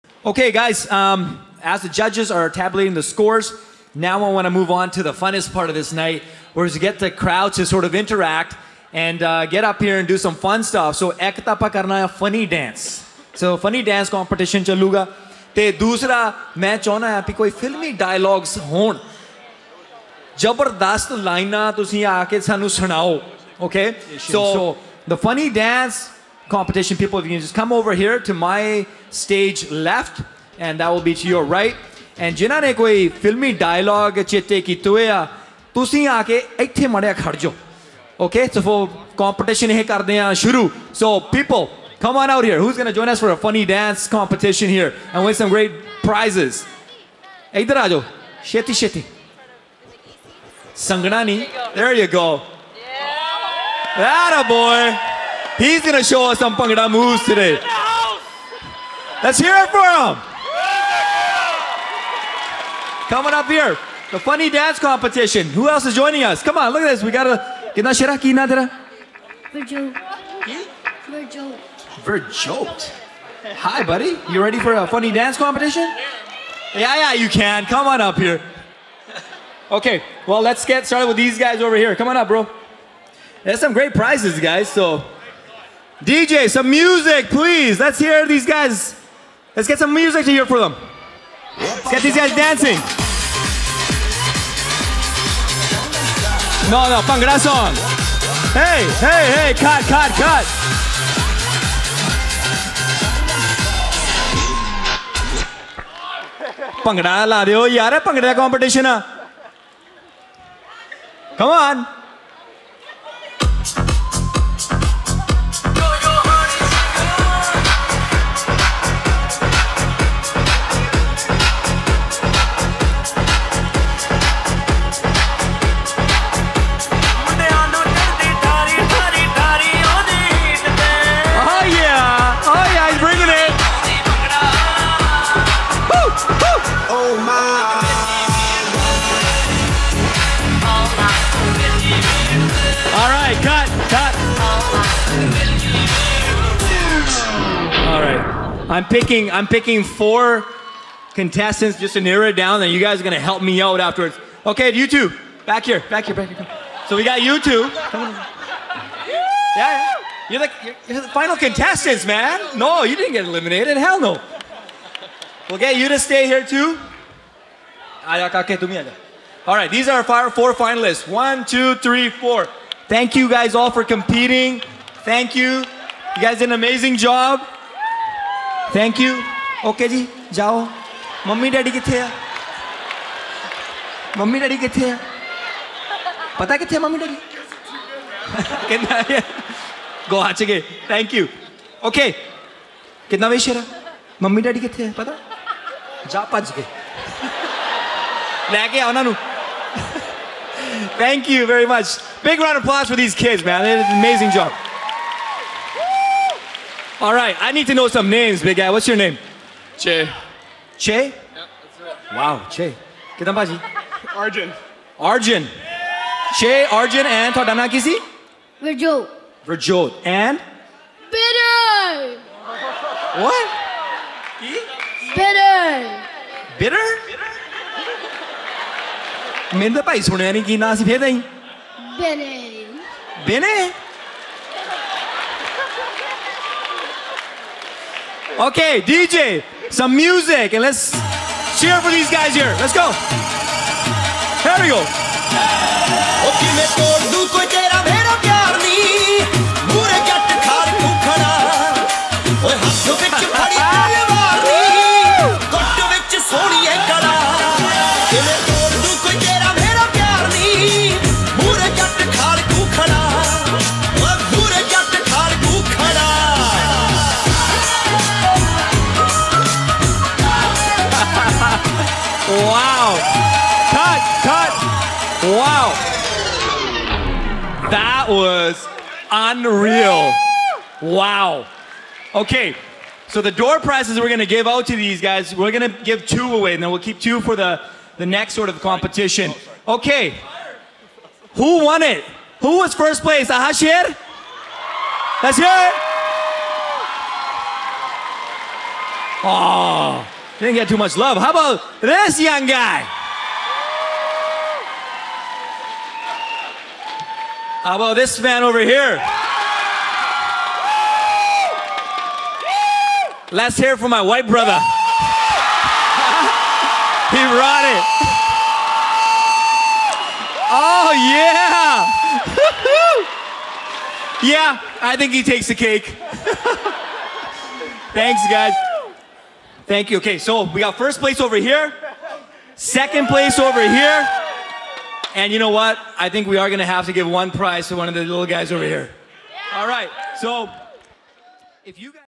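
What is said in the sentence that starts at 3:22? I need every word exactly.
Big round of applause for these kids, man.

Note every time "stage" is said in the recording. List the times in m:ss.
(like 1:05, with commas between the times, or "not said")
0:29.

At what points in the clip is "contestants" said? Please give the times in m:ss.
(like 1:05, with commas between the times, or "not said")
2:31, 2:41.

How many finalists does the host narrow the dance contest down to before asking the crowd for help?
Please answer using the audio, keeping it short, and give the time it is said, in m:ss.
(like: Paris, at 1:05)
4, at 2:29.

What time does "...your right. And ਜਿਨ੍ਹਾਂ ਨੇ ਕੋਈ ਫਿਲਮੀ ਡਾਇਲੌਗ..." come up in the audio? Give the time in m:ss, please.
0:31.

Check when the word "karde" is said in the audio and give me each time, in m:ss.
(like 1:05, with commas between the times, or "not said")
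0:39.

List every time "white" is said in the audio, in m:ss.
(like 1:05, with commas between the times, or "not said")
5:14.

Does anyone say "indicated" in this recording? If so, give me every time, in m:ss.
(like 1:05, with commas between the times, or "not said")
not said.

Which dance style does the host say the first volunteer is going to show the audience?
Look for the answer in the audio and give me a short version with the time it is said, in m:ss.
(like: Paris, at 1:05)
Bhangra, at 0:56.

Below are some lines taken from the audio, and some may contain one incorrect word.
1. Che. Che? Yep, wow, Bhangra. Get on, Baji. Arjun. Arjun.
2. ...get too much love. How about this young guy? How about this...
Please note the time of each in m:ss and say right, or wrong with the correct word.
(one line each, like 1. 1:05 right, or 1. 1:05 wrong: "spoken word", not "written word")
1. 3:29 wrong: "Che", not "Bhangra"
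2. 5:00 right.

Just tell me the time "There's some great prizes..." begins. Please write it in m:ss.
1:23.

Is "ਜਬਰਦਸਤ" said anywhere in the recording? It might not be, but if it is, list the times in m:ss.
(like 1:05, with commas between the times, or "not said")
0:20.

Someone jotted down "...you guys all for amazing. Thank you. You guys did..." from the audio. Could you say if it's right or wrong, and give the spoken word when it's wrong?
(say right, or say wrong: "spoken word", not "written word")
wrong: "competing", not "amazing".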